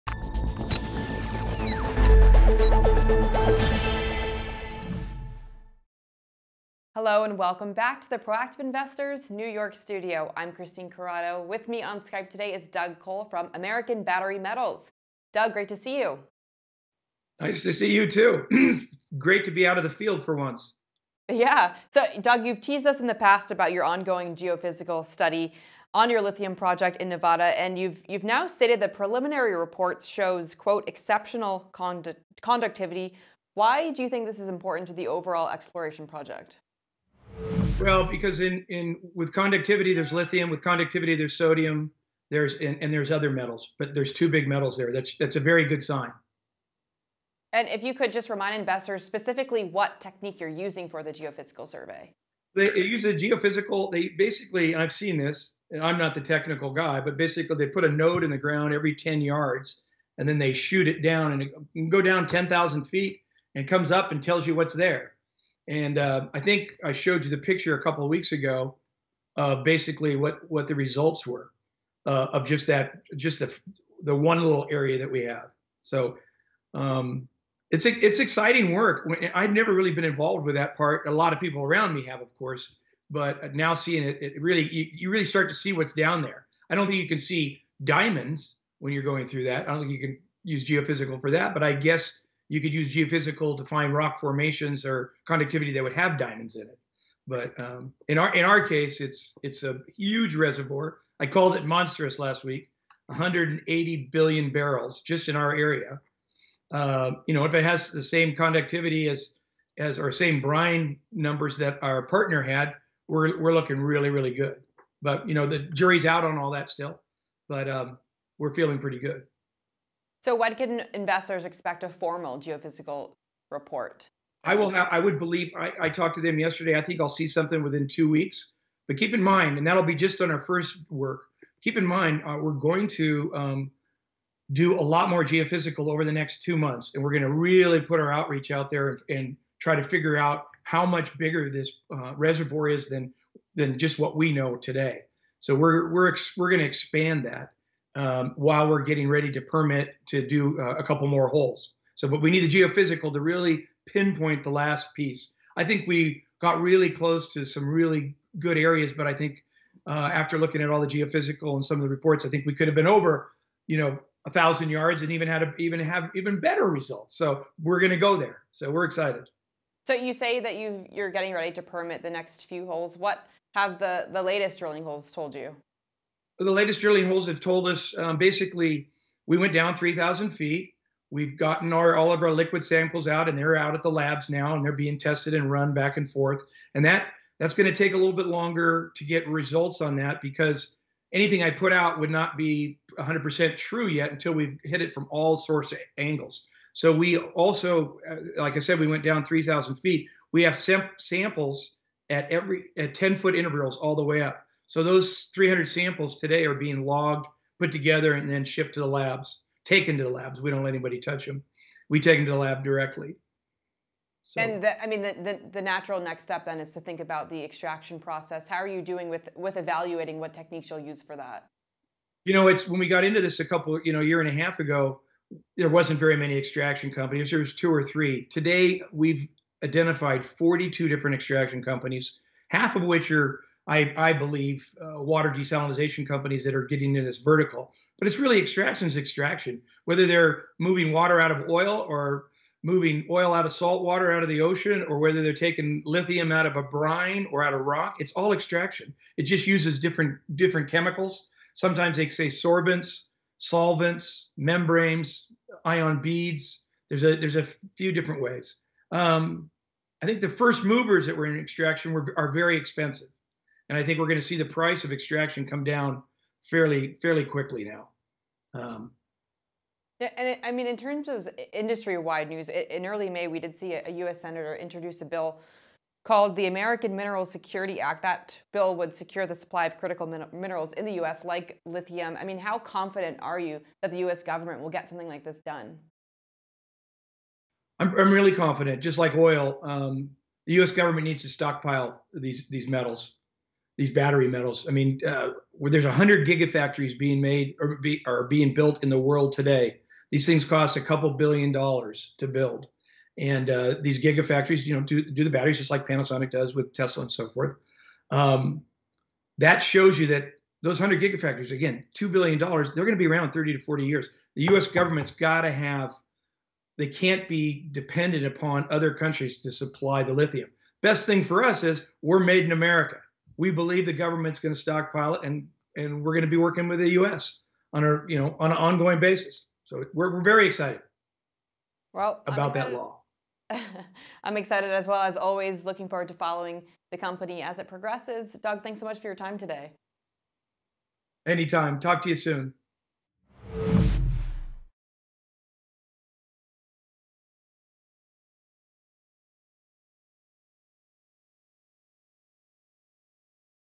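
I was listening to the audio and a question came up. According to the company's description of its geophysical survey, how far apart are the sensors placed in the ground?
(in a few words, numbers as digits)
10 yards.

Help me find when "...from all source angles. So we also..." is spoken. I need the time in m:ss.
3:14.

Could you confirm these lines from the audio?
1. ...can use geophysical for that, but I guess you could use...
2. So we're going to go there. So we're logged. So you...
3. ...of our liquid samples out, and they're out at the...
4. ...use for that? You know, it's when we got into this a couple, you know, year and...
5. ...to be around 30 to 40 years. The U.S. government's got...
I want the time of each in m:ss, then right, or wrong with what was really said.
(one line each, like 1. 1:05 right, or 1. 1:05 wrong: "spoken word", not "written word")
1. 1:29 right
2. 2:47 wrong: "excited", not "logged"
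3. 3:02 right
4. 3:40 right
5. 5:12 right.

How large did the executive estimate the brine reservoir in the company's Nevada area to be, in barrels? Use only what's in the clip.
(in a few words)
180 billion barrels.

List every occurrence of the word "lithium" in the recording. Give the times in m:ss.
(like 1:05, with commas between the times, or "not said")
0:26, 0:40, 4:05, 4:41, 5:20.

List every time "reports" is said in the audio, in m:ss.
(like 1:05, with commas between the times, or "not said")
0:29, 2:03, 2:41.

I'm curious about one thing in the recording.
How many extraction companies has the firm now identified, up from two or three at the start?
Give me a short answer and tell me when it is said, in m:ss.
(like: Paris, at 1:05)
42, at 3:50.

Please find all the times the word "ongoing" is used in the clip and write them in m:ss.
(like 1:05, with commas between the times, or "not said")
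0:23, 5:28.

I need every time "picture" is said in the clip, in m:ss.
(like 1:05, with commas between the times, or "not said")
1:07.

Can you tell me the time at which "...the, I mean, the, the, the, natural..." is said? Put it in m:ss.
3:34.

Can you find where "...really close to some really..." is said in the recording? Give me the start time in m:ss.
2:36.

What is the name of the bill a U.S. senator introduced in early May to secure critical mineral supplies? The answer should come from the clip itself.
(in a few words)
American Mineral Security Act.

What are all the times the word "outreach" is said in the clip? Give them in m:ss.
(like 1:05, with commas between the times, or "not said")
2:18.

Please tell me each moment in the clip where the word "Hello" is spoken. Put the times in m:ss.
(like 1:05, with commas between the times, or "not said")
0:07.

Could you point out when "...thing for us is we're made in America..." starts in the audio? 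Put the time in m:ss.
5:21.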